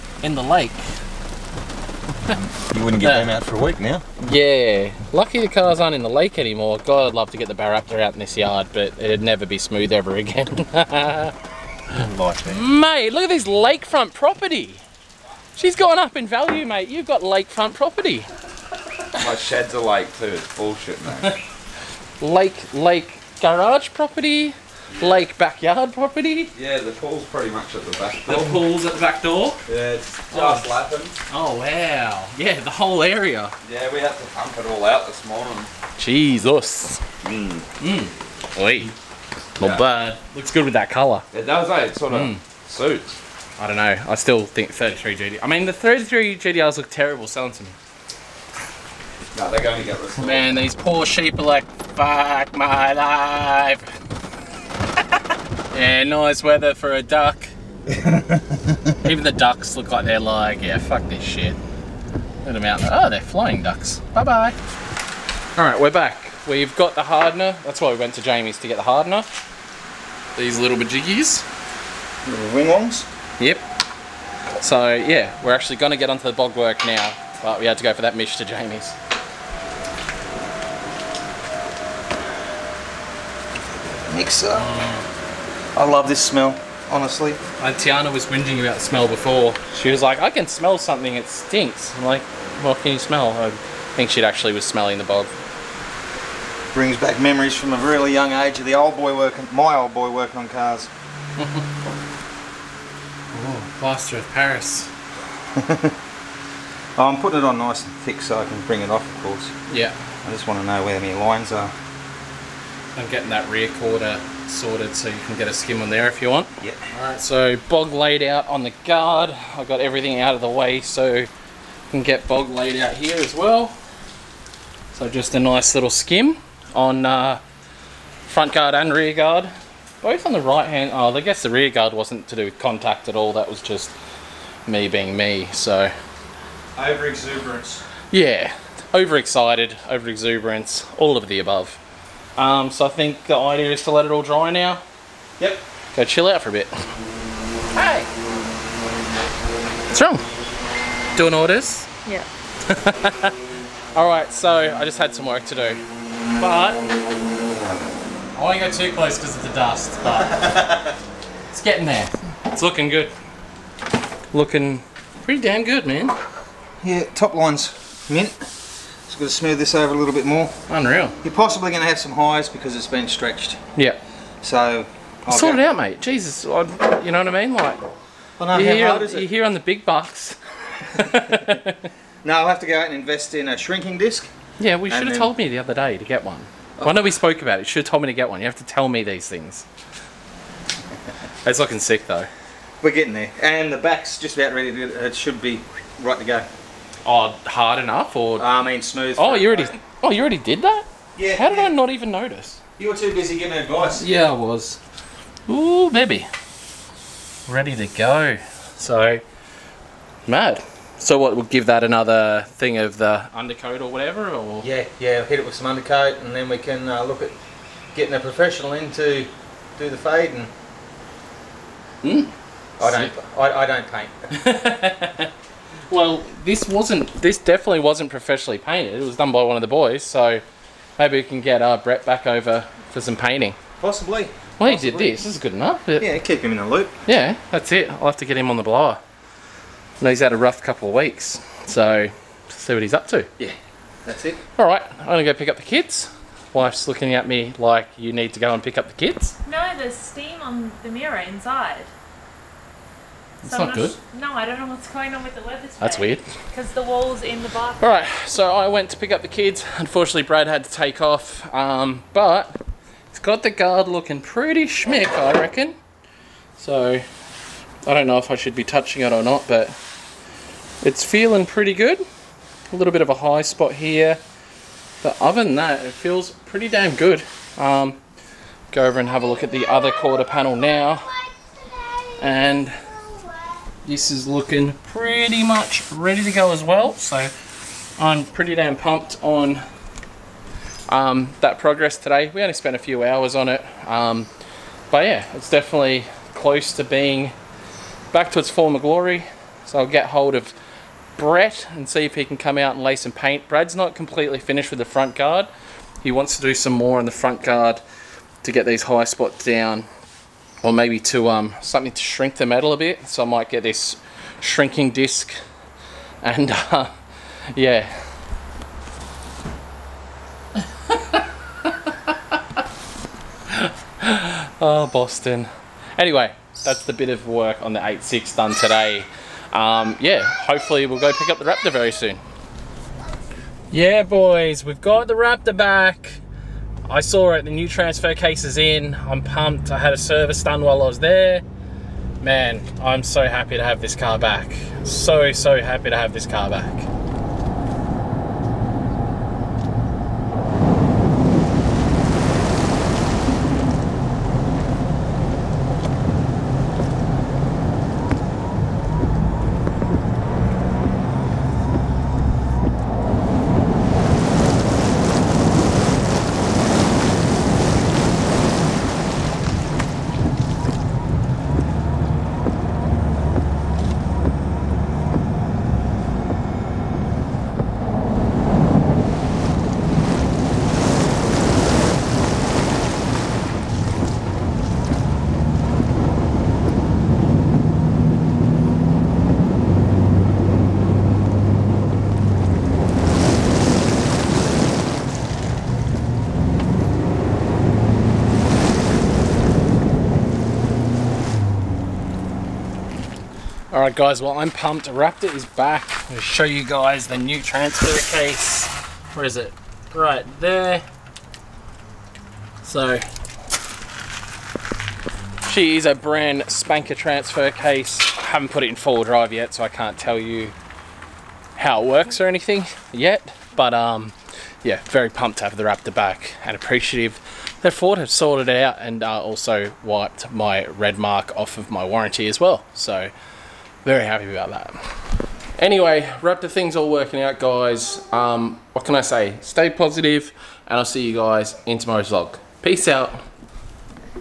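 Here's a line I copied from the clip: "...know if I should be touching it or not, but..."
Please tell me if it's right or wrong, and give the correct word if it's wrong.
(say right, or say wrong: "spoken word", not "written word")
right.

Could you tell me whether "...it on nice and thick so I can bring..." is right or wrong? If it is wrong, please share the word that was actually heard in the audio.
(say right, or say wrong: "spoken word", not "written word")
right.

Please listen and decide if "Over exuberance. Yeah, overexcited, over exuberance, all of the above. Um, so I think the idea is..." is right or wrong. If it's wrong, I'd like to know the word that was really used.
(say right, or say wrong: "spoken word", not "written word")
right.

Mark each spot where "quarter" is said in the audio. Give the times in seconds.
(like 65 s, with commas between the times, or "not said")
113 s, 279 s.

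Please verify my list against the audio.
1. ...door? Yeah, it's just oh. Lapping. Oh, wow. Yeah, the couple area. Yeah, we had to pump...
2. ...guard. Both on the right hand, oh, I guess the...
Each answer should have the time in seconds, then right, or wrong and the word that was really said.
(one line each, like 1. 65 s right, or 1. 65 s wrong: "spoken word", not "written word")
1. 29 s wrong: "whole", not "couple"
2. 129 s right.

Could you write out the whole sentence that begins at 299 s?
So I'll get hold of Brett and see if he can come out and lay some paint.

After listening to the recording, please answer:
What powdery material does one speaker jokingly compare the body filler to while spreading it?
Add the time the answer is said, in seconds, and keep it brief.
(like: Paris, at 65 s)
Plaster of Paris, at 103 s.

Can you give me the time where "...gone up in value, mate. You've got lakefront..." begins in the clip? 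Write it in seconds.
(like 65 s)
15 s.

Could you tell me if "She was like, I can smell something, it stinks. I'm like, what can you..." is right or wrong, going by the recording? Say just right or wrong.
right.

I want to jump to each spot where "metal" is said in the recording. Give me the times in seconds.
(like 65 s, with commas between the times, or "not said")
312 s.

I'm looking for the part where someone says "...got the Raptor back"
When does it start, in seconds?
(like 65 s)
334 s.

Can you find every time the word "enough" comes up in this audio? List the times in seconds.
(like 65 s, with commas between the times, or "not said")
197 s, 235 s.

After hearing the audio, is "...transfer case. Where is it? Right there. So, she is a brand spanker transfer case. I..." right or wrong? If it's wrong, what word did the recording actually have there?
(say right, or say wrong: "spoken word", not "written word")
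right.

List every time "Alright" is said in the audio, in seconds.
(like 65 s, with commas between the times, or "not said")
116 s, 153 s, 257 s.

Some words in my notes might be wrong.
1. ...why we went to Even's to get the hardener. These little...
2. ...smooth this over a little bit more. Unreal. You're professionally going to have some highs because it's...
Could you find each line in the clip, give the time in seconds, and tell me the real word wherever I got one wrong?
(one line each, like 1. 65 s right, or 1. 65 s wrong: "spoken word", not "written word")
1. 67 s wrong: "Jamie", not "Even"
2. 169 s wrong: "possibly", not "professionally".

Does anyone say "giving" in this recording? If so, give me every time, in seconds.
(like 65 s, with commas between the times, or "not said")
203 s.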